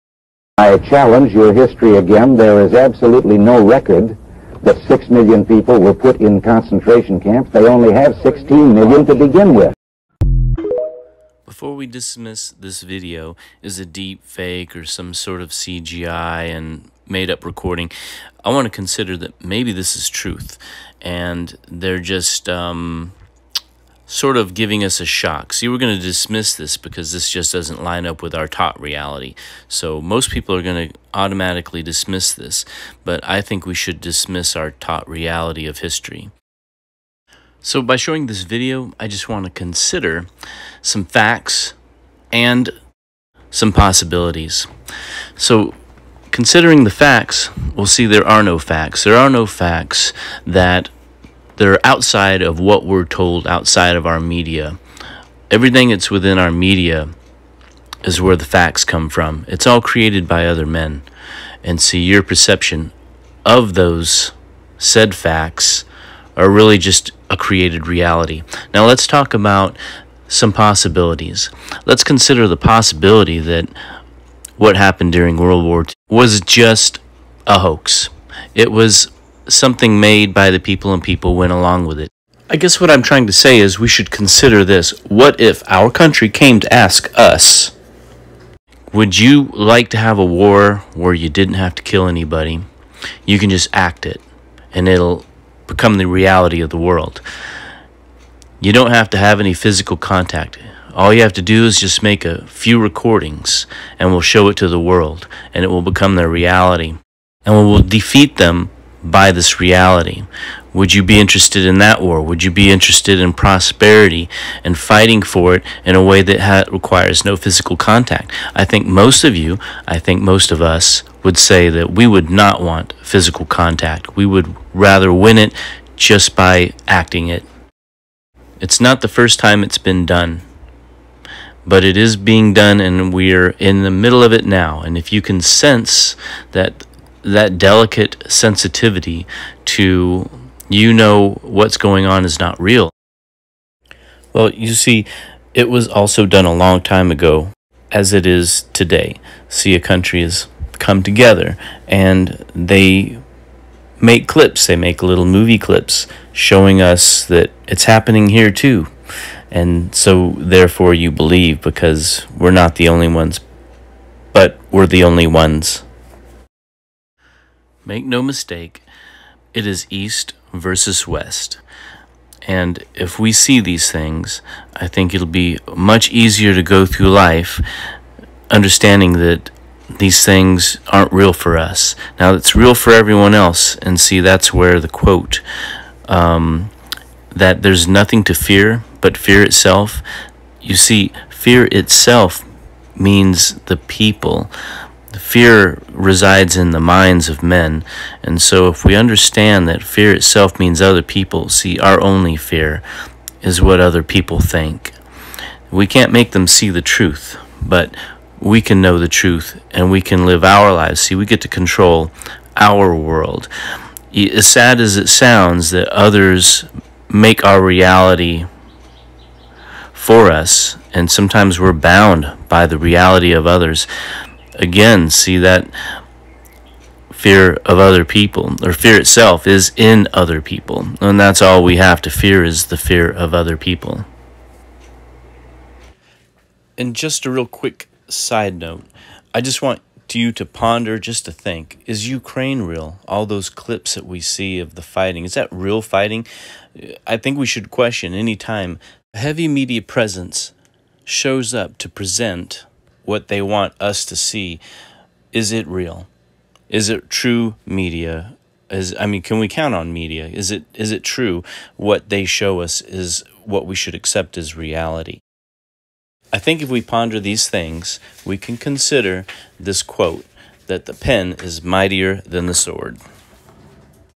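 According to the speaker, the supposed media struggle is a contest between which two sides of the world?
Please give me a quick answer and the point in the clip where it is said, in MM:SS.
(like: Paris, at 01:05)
East versus West, at 02:49.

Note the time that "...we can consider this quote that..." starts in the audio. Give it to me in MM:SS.
04:28.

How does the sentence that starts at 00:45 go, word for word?
So considering the facts, we'll see there are no facts.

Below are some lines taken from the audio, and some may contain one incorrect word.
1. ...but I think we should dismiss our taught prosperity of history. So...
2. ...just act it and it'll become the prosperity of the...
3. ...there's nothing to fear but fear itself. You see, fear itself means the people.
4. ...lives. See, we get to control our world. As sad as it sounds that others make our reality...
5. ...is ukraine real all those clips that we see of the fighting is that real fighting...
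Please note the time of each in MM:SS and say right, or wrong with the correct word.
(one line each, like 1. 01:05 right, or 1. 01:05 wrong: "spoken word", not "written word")
1. 00:33 wrong: "reality", not "prosperity"
2. 01:33 wrong: "reality", not "prosperity"
3. 03:07 right
4. 03:30 right
5. 04:01 right.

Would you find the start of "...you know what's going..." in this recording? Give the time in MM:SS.
02:20.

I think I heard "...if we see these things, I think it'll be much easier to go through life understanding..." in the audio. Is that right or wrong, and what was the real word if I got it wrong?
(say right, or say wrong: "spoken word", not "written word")
right.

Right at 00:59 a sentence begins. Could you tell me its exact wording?
It's all created by other men.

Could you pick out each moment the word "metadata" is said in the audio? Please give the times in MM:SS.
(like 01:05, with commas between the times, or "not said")
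not said.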